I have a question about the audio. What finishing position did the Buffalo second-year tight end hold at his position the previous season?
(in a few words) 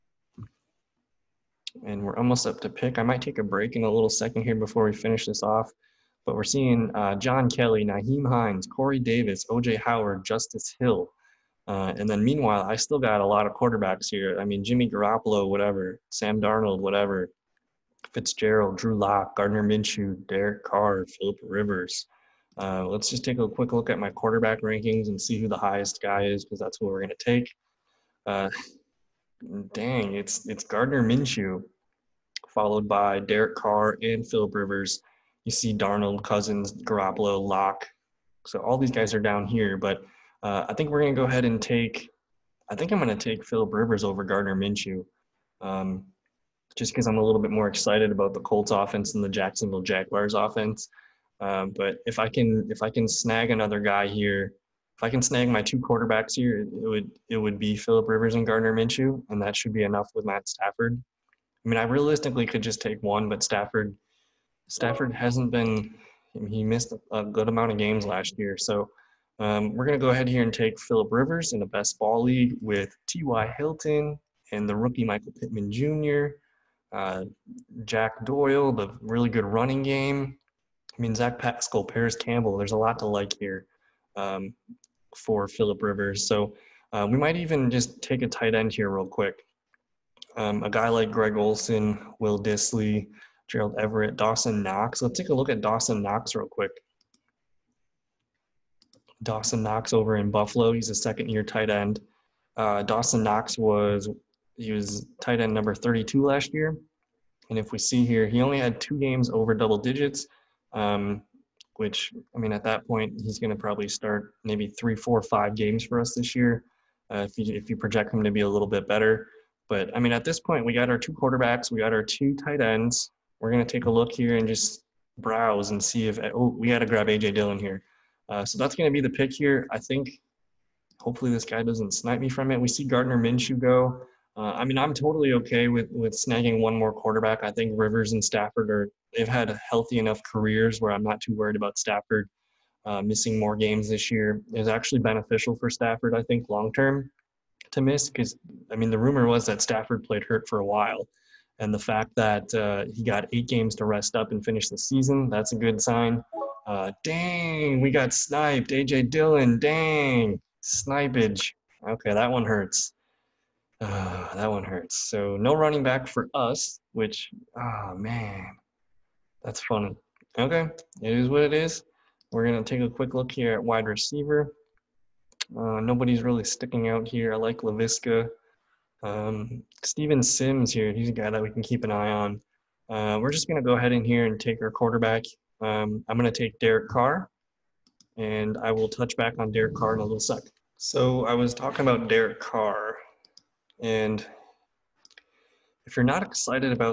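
32.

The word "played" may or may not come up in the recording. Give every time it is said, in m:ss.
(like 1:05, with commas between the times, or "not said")
2:30.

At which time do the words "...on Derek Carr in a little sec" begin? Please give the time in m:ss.
3:09.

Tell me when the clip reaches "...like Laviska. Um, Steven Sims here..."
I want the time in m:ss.
2:57.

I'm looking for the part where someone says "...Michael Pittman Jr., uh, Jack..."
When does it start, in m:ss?
1:15.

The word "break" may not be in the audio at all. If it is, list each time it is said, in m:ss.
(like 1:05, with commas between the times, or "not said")
0:03.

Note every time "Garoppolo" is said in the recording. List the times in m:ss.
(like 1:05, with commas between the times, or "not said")
0:14, 0:36.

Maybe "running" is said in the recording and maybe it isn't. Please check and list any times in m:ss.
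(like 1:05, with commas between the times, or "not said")
1:19, 2:45.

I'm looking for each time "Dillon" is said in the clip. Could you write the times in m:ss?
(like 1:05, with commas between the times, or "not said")
2:07, 2:39.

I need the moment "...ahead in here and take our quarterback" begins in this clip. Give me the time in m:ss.
3:03.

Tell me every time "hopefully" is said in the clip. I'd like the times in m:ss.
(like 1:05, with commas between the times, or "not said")
2:10.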